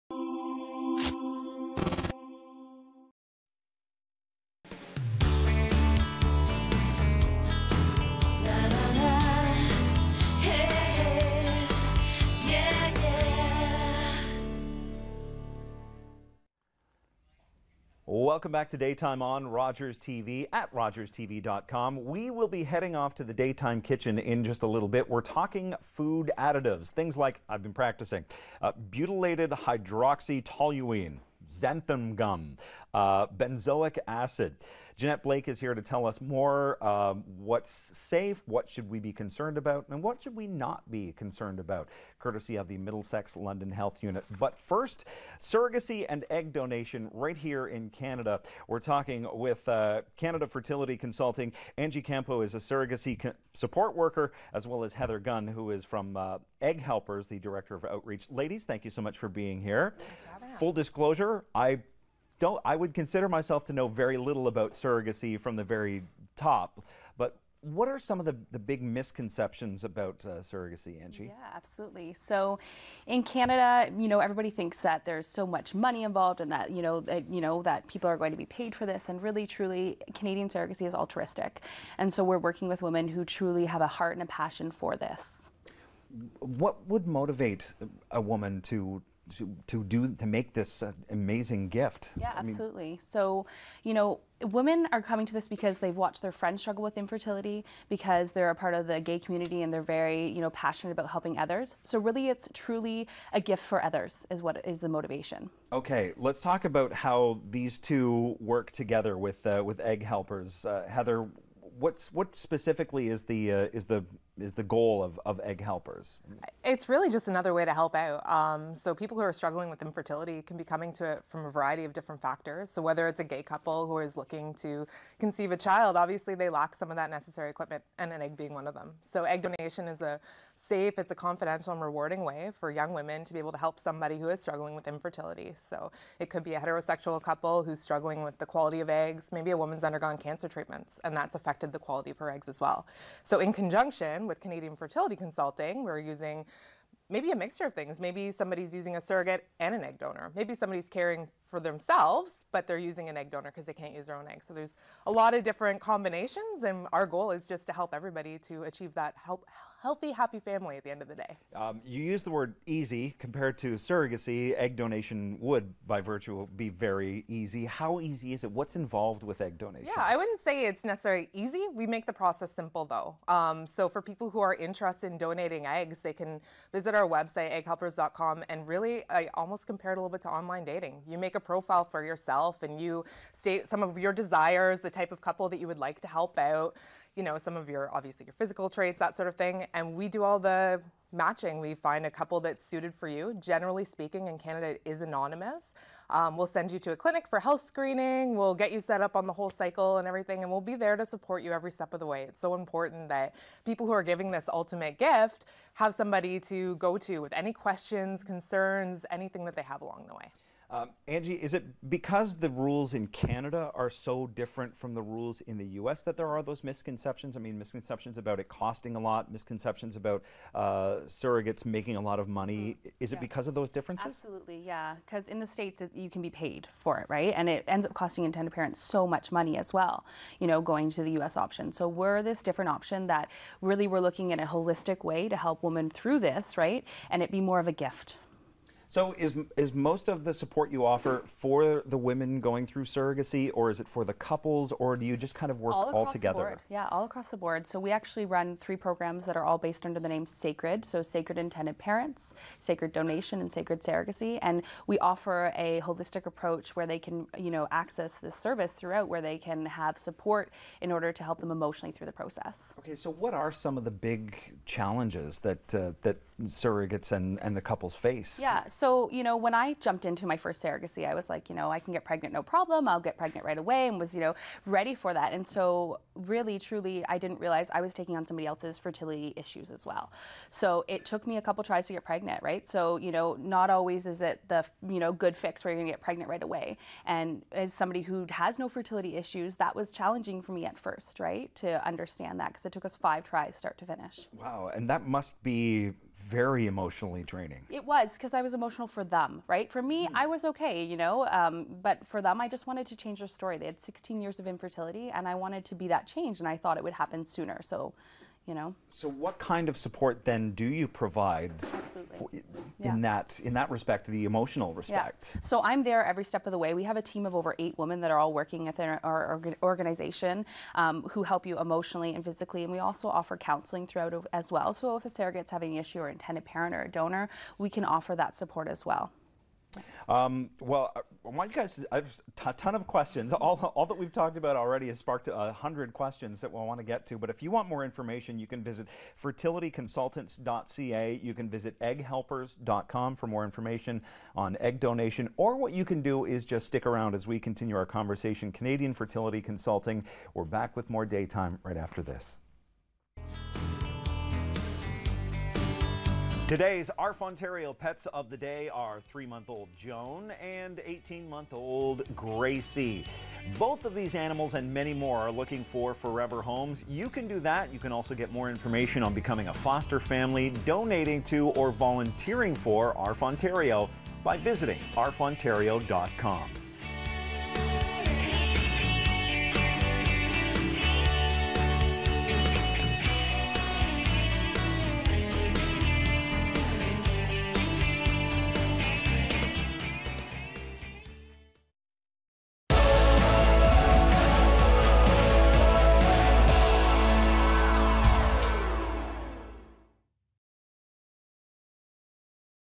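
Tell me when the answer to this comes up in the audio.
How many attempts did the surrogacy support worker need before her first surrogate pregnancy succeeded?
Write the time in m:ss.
4:52.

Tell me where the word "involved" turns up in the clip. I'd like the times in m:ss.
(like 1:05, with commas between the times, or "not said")
1:16, 2:48.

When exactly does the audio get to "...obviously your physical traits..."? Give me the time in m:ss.
3:07.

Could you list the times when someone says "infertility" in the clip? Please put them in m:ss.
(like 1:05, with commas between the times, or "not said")
1:36, 1:59, 2:14, 5:04.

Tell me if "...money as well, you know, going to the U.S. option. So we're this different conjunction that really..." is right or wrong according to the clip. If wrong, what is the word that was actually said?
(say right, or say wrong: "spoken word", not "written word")
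wrong: "option", not "conjunction".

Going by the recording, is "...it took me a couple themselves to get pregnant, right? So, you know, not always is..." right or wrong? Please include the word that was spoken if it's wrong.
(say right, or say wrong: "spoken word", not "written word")
wrong: "tries", not "themselves".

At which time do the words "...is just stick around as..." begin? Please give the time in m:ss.
5:46.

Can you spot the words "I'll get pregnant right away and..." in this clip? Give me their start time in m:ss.
4:32.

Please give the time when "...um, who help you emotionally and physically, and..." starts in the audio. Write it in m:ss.
5:20.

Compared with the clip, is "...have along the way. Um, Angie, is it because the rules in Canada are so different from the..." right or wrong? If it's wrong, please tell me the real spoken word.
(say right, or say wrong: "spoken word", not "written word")
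right.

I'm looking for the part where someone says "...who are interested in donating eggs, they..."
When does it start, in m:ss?
2:54.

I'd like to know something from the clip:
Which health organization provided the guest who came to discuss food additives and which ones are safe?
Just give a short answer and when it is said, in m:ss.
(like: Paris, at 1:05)
Middlesex London Health Unit, at 0:42.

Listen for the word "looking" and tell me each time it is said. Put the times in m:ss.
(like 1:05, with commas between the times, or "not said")
2:04, 3:53, 6:05.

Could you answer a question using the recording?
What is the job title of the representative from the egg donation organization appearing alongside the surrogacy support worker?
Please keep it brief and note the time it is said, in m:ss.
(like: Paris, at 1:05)
Director of Outreach, at 0:57.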